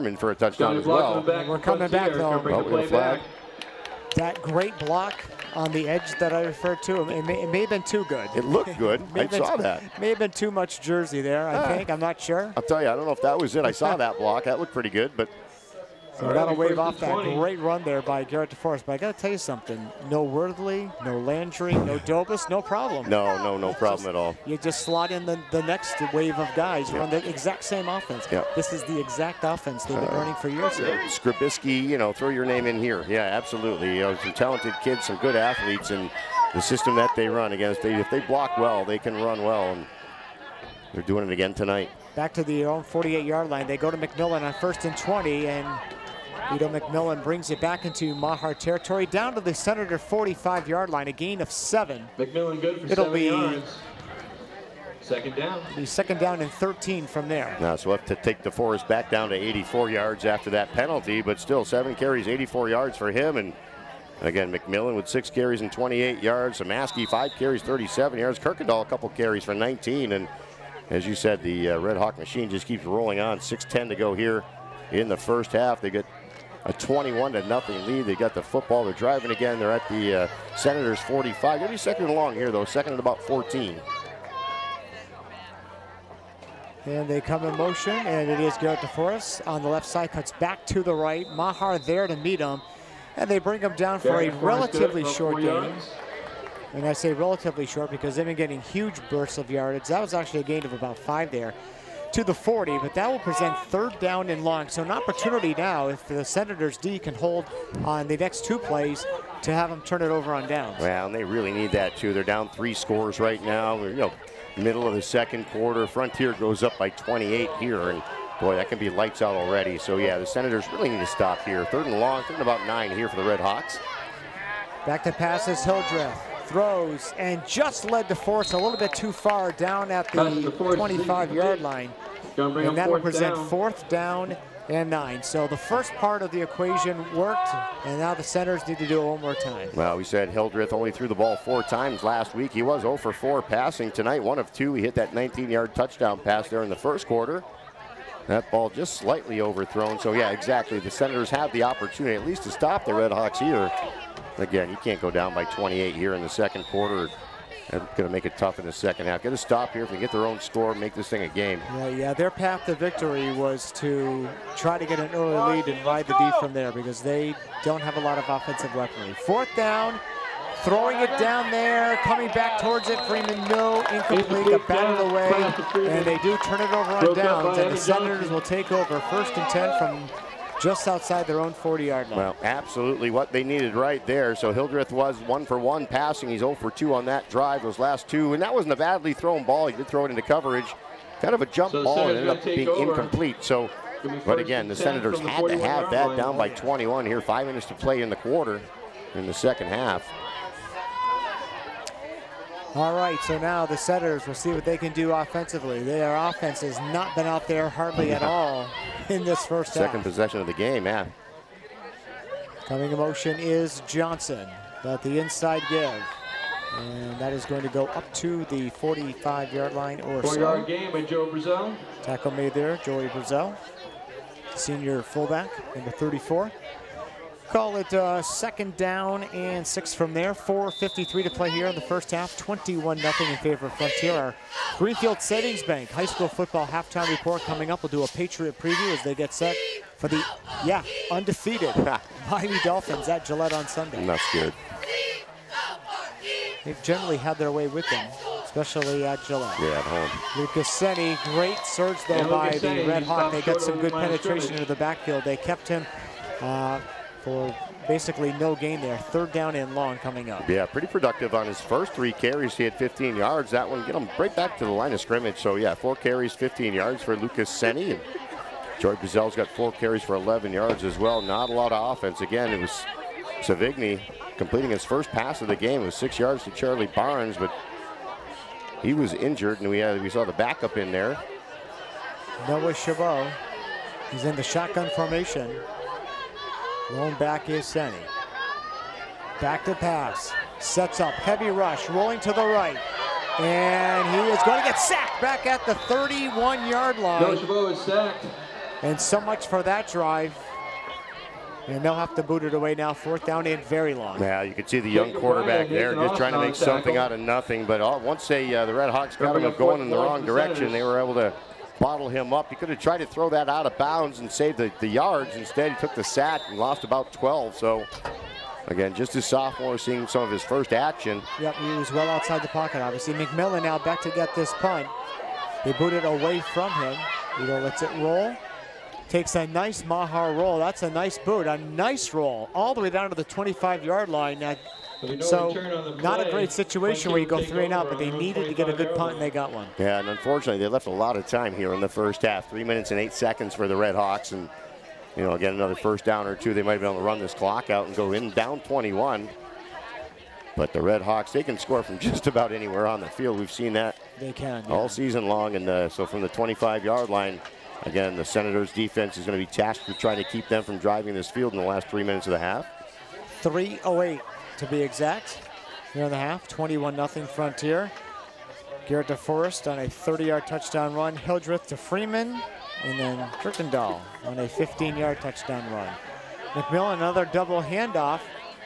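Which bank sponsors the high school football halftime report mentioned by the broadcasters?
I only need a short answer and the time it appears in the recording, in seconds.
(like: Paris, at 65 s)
Greenfield Savings Bank, at 234 s.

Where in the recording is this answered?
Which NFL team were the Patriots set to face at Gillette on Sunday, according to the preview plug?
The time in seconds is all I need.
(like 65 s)
242 s.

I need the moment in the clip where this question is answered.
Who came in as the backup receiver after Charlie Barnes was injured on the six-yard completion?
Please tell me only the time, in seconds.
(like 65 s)
282 s.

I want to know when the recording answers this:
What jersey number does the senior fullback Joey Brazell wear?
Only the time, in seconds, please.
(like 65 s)
225 s.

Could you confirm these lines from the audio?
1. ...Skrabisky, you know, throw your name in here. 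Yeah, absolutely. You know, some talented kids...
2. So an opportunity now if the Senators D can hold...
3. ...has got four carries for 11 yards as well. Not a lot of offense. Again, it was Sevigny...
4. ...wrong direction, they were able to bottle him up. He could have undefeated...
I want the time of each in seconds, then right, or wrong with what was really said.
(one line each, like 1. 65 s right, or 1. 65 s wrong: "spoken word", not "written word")
1. 31 s right
2. 104 s right
3. 268 s right
4. 309 s wrong: "tried", not "undefeated".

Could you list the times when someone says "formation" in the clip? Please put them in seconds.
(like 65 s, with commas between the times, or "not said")
284 s.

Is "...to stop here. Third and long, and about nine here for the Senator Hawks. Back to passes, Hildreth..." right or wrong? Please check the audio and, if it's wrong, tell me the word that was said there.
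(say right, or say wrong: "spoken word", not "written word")
wrong: "Red", not "Senator".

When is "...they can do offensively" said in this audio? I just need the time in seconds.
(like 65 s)
204 s.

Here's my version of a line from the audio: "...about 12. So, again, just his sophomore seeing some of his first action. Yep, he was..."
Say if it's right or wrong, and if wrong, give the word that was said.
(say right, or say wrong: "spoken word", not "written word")
right.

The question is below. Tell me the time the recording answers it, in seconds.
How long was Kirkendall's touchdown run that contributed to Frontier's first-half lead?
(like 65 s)
374 s.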